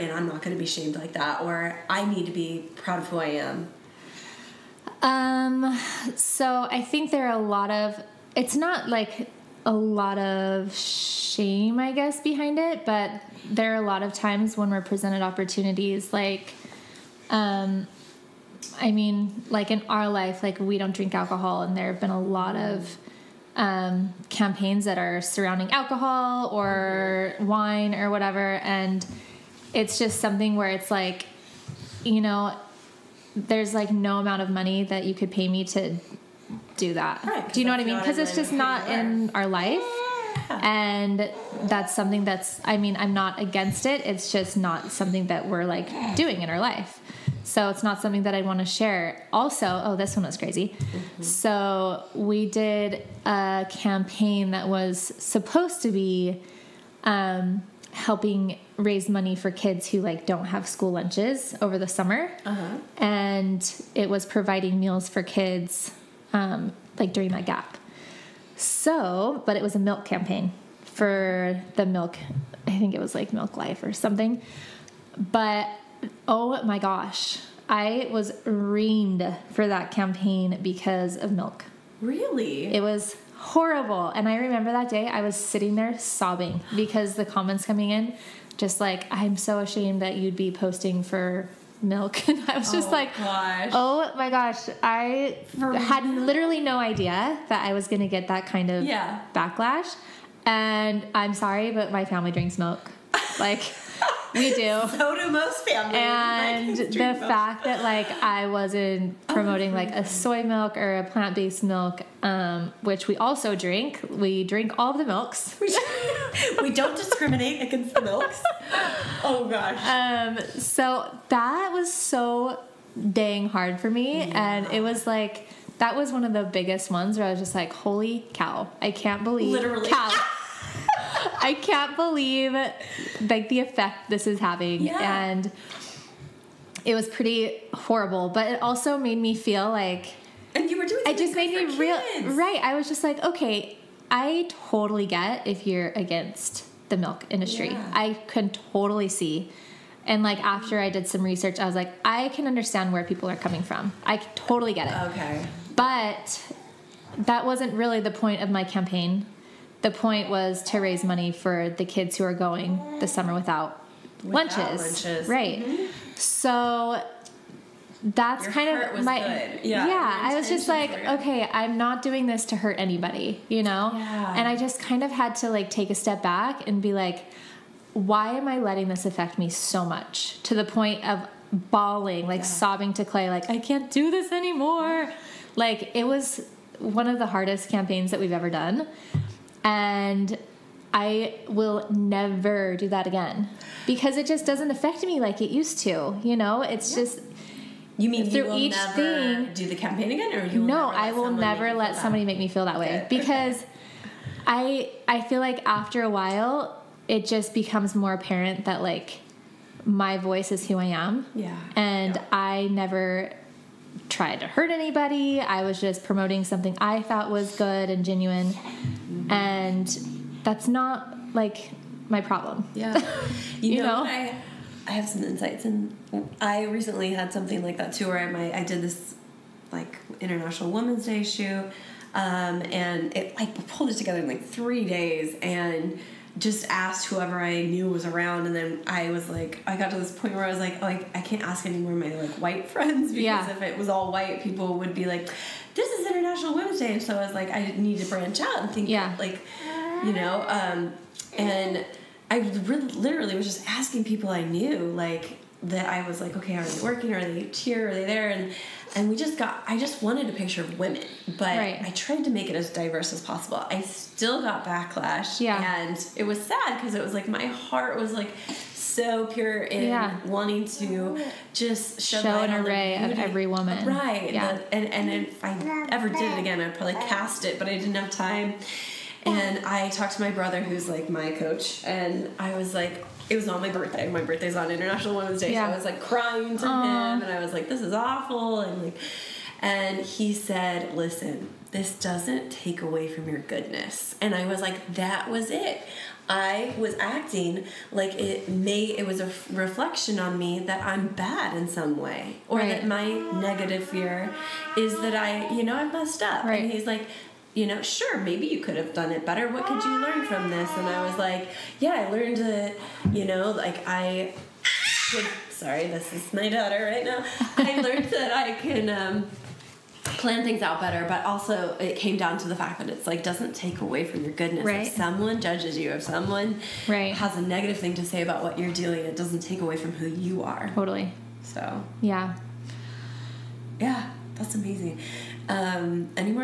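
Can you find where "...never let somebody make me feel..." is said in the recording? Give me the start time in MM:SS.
03:21.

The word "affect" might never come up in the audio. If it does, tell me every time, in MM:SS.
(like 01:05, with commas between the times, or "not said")
02:59, 03:14.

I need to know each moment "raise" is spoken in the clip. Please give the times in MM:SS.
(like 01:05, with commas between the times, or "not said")
00:58, 02:40.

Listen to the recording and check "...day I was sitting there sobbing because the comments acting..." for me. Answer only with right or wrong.
wrong.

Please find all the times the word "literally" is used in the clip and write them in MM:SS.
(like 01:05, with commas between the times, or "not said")
01:36, 02:09, 04:12.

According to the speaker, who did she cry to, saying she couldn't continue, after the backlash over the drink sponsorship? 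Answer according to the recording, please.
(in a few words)
Clay.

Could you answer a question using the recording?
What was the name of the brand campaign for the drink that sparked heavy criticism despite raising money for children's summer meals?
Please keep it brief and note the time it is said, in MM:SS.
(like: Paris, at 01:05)
Milk Life, at 01:13.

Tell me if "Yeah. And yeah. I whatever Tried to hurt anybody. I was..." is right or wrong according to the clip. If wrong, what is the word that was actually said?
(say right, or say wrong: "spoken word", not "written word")
wrong: "never", not "whatever".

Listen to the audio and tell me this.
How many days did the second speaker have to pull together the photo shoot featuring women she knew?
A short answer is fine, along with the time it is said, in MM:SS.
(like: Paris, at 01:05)
3, at 03:54.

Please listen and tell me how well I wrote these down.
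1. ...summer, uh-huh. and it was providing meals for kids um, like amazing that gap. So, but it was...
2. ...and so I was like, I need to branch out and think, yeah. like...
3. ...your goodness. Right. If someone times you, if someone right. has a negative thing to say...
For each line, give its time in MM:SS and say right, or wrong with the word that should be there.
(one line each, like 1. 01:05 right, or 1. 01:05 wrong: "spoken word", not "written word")
1. 01:01 wrong: "during", not "amazing"
2. 04:06 right
3. 05:24 wrong: "judges", not "times".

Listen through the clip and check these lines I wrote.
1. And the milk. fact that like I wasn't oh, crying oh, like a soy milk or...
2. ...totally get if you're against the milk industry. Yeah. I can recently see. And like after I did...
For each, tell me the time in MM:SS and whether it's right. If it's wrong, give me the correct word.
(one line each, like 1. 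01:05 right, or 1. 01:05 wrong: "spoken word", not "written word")
1. 01:46 wrong: "promoting", not "crying"
2. 02:24 wrong: "totally", not "recently".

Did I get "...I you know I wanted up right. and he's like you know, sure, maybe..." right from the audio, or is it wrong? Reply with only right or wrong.
wrong.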